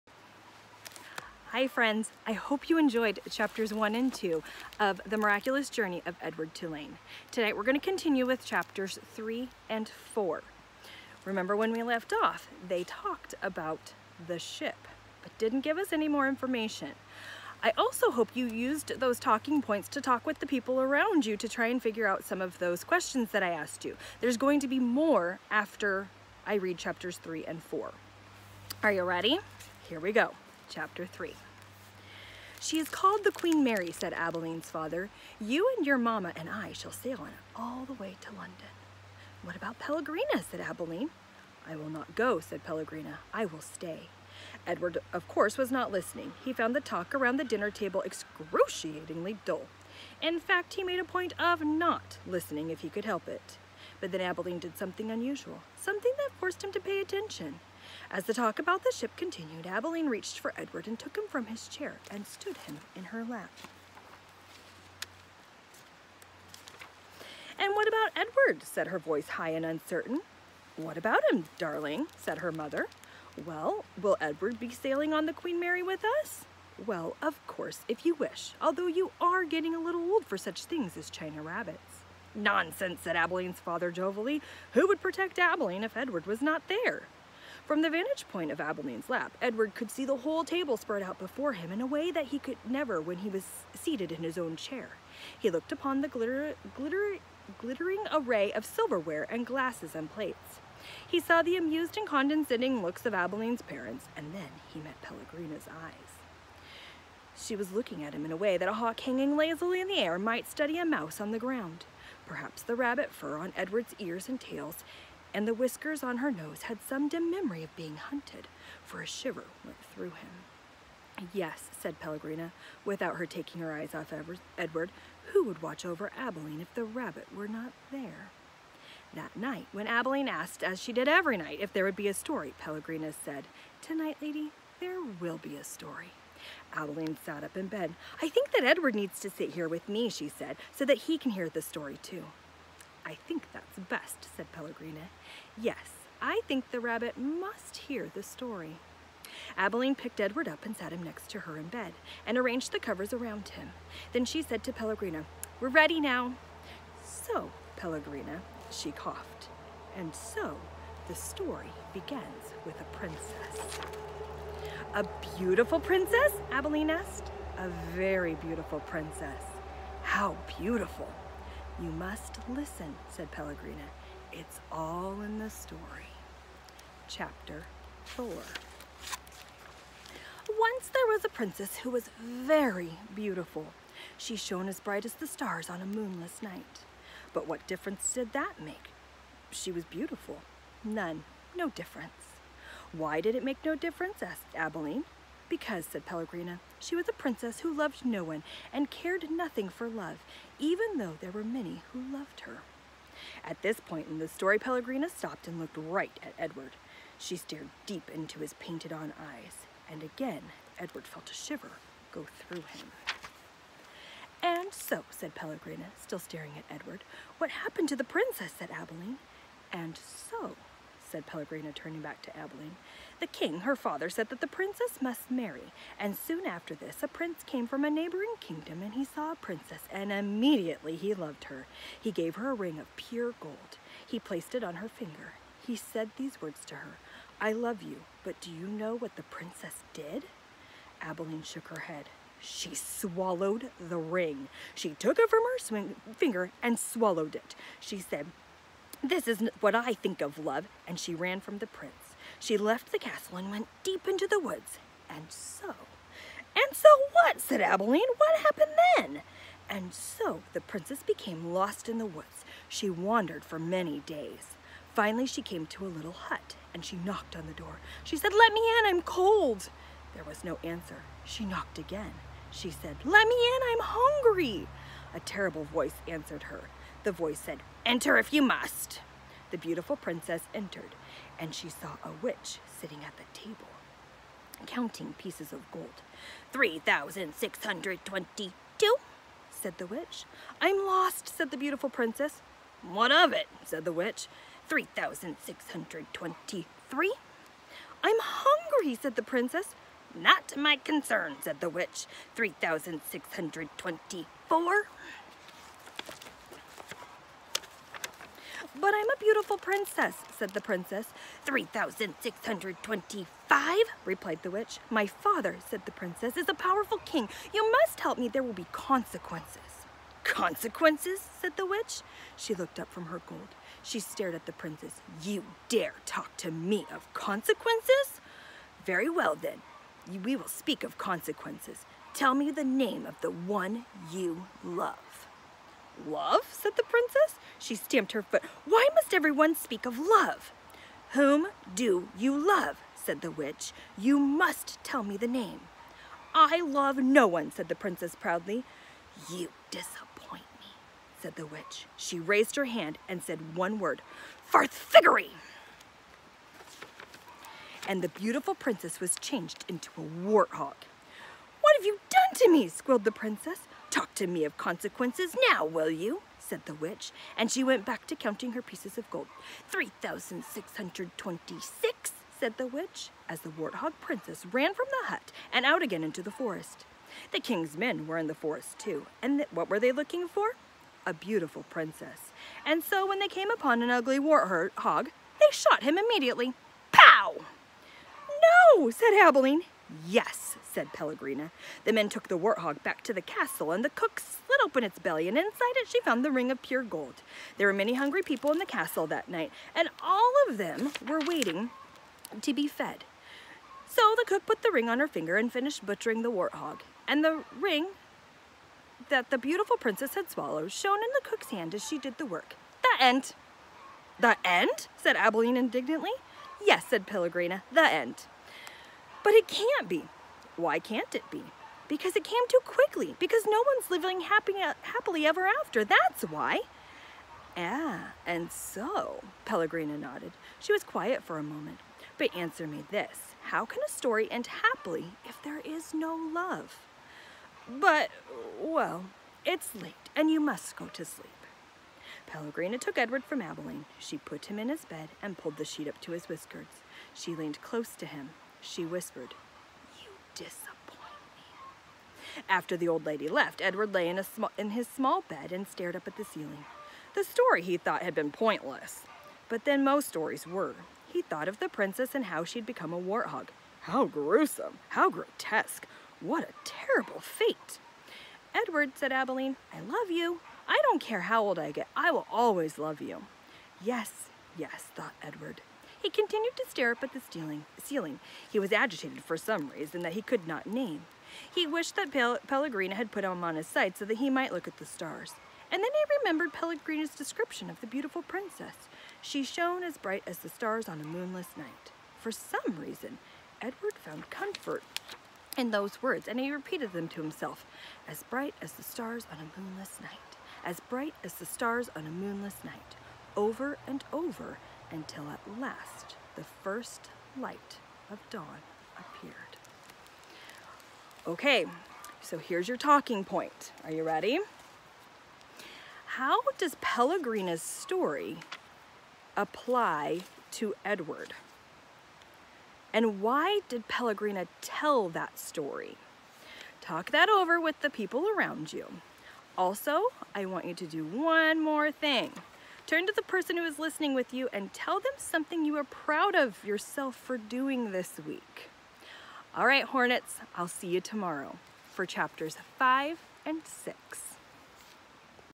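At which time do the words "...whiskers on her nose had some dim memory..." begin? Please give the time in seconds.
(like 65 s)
115 s.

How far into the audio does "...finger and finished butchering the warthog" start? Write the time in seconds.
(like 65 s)
405 s.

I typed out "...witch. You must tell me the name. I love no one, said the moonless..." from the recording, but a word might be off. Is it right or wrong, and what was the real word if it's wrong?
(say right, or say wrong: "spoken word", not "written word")
wrong: "princess", not "moonless".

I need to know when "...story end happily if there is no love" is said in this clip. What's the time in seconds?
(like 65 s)
433 s.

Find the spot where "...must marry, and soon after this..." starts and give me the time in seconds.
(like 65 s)
225 s.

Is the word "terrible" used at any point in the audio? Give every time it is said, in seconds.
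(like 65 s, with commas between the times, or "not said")
275 s, 466 s.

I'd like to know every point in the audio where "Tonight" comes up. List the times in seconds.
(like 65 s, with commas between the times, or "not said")
7 s, 133 s.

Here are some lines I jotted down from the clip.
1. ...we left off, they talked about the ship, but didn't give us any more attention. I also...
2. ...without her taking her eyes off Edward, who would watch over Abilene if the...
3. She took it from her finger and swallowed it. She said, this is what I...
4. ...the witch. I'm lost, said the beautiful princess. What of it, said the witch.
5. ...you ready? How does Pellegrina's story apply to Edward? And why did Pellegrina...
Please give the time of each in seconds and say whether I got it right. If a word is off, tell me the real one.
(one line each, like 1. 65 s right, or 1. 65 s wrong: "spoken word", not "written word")
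1. 11 s wrong: "information", not "attention"
2. 122 s right
3. 244 s right
4. 289 s right
5. 513 s right.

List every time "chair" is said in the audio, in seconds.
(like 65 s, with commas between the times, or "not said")
61 s, 94 s.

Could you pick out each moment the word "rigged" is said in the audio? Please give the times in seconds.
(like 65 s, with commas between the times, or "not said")
not said.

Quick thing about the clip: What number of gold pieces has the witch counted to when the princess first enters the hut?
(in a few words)
3,622.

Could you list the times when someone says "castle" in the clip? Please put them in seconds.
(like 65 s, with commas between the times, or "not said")
252 s, 393 s, 398 s.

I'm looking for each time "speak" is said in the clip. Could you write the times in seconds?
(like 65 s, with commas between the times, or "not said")
330 s, 339 s.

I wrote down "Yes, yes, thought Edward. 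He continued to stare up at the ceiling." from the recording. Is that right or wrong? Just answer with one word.
right.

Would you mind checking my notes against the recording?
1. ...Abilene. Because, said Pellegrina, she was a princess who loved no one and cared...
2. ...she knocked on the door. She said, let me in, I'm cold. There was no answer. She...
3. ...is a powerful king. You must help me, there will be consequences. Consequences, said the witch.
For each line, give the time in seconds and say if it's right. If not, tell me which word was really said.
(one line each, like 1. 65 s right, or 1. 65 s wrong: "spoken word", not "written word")
1. 194 s right
2. 266 s right
3. 316 s right.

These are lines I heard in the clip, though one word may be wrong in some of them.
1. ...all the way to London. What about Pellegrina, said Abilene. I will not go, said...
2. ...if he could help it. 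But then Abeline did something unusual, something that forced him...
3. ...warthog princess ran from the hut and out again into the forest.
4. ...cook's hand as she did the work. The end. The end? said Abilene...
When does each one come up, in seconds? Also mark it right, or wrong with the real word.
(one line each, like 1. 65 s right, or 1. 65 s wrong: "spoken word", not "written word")
1. 37 s right
2. 52 s right
3. 373 s right
4. 411 s right.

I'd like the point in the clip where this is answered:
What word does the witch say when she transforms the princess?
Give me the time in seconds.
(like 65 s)
354 s.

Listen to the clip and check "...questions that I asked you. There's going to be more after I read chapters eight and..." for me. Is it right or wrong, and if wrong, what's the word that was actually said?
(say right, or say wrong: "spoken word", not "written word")
wrong: "three", not "eight".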